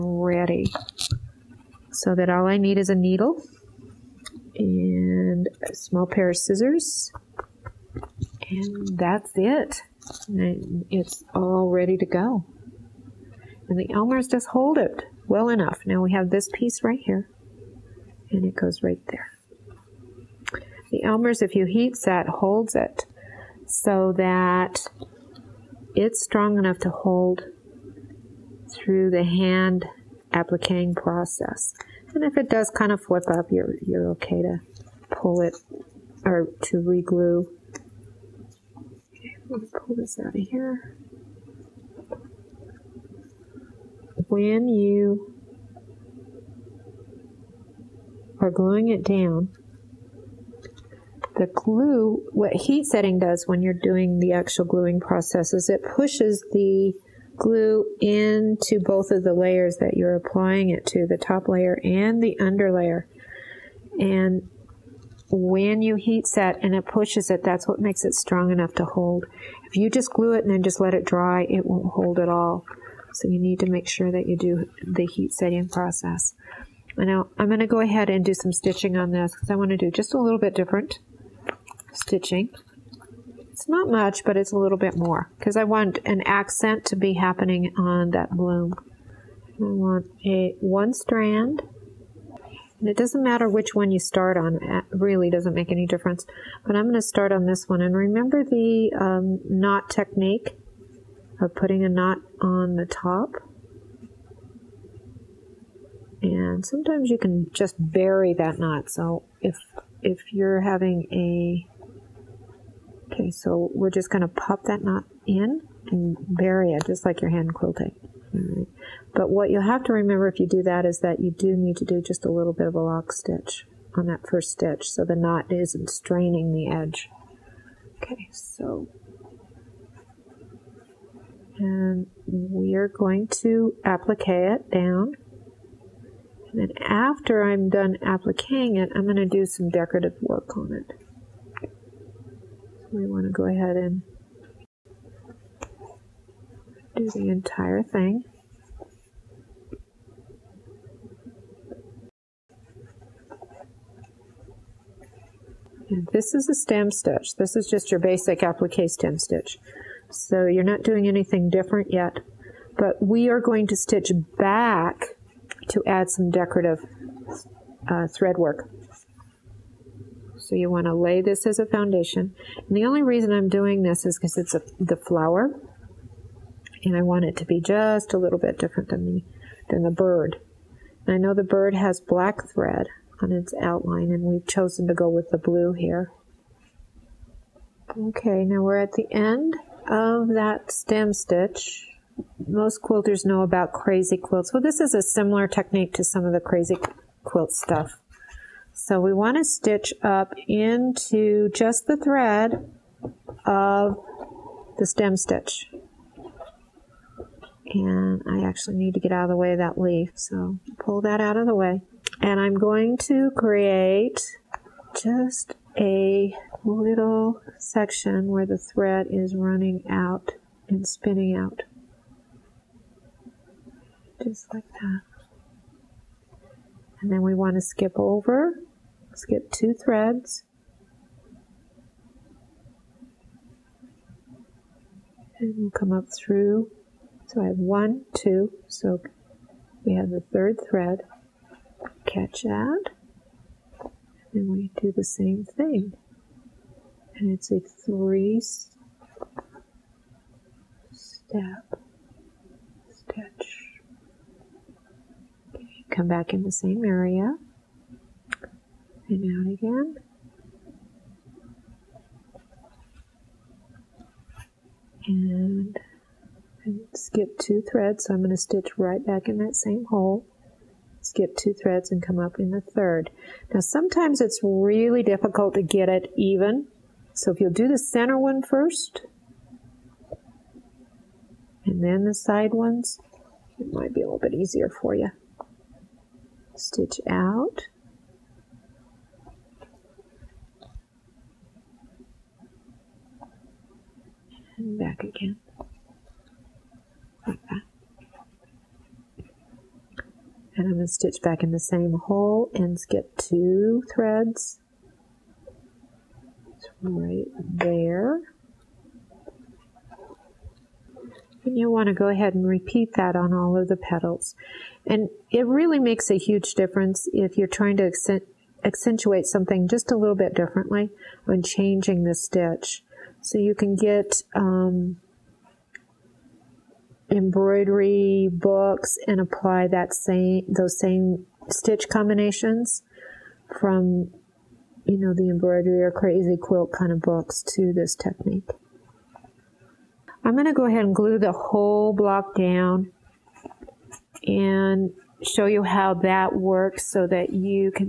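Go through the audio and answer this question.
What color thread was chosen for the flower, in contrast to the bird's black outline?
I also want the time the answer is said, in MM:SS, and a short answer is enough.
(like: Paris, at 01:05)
blue, at 03:05.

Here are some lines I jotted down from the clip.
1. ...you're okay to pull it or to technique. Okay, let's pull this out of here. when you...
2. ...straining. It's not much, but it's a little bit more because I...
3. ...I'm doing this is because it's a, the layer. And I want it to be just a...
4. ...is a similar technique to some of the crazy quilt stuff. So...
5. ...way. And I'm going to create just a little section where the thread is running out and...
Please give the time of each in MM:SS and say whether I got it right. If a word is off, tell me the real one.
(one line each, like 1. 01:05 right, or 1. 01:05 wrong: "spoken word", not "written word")
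1. 00:33 wrong: "reglue", not "technique"
2. 01:21 wrong: "stitching", not "straining"
3. 02:53 wrong: "flower", not "layer"
4. 03:14 right
5. 03:31 right.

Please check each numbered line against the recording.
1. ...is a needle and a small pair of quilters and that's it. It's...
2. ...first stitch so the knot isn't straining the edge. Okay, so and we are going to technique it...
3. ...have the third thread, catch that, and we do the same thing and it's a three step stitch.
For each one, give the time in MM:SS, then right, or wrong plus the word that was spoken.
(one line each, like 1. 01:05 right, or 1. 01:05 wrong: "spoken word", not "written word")
1. 00:02 wrong: "scissors", not "quilters"
2. 02:04 wrong: "applique", not "technique"
3. 03:59 right.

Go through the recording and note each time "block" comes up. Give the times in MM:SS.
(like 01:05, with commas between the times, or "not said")
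05:41.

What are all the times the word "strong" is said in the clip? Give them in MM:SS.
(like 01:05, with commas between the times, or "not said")
00:26, 01:08.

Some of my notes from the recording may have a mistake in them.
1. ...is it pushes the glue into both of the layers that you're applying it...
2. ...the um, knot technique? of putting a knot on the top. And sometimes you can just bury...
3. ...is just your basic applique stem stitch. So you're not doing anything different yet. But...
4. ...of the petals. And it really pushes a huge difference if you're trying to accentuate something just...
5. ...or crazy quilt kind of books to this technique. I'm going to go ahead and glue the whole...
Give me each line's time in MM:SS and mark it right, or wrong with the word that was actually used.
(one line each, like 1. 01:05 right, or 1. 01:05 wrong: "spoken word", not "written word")
1. 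00:55 right
2. 01:38 right
3. 02:37 right
4. 05:13 wrong: "makes", not "pushes"
5. 05:35 right.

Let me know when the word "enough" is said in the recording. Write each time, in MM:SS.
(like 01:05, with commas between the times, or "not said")
00:15, 00:26, 01:08.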